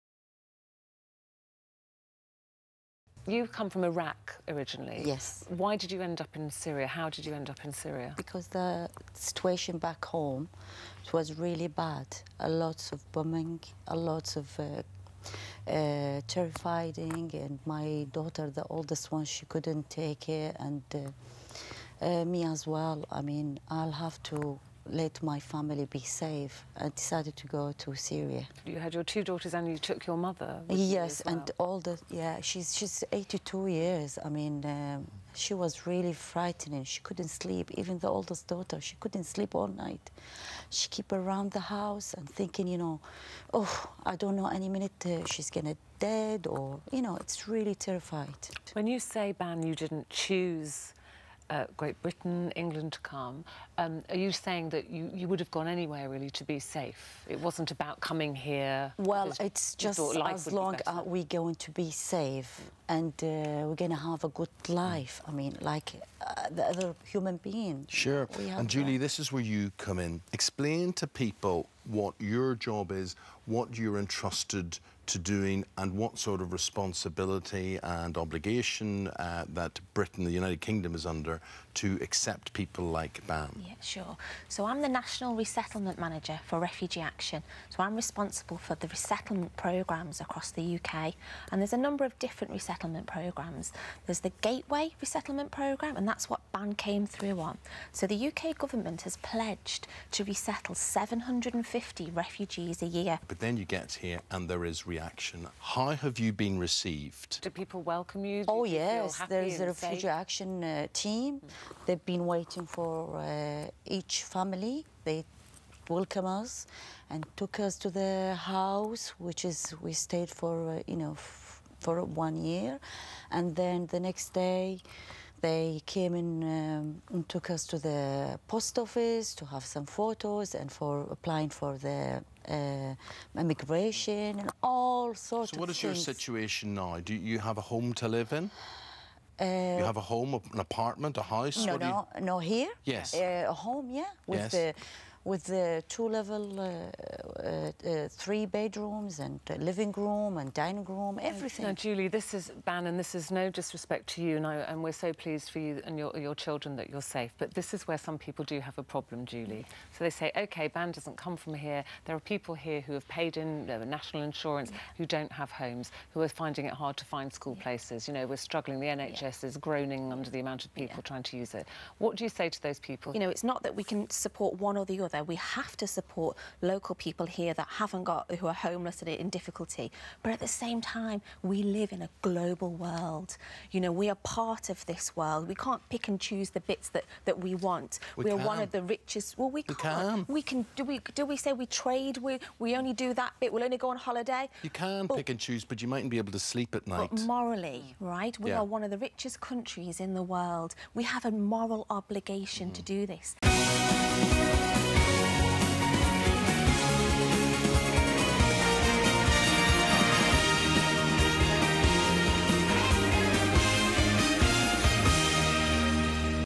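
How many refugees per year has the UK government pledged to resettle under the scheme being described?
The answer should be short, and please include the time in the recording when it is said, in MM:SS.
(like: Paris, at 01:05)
750, at 01:40.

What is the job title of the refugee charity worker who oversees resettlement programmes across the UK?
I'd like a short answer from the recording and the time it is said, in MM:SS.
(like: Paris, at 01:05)
National Resettlement Manager, at 01:24.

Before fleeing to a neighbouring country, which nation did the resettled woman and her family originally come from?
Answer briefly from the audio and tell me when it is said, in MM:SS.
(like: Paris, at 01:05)
Iraq, at 00:03.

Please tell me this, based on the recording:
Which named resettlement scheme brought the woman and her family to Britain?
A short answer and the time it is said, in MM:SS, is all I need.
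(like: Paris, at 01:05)
Gateway Resettlement Programme, at 01:34.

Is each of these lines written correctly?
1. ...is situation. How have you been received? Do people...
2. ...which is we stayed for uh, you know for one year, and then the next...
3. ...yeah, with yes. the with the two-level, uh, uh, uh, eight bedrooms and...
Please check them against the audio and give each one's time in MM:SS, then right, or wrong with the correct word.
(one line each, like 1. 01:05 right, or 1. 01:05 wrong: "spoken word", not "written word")
1. 01:44 wrong: "reaction", not "situation"
2. 01:59 right
3. 02:23 wrong: "three", not "eight".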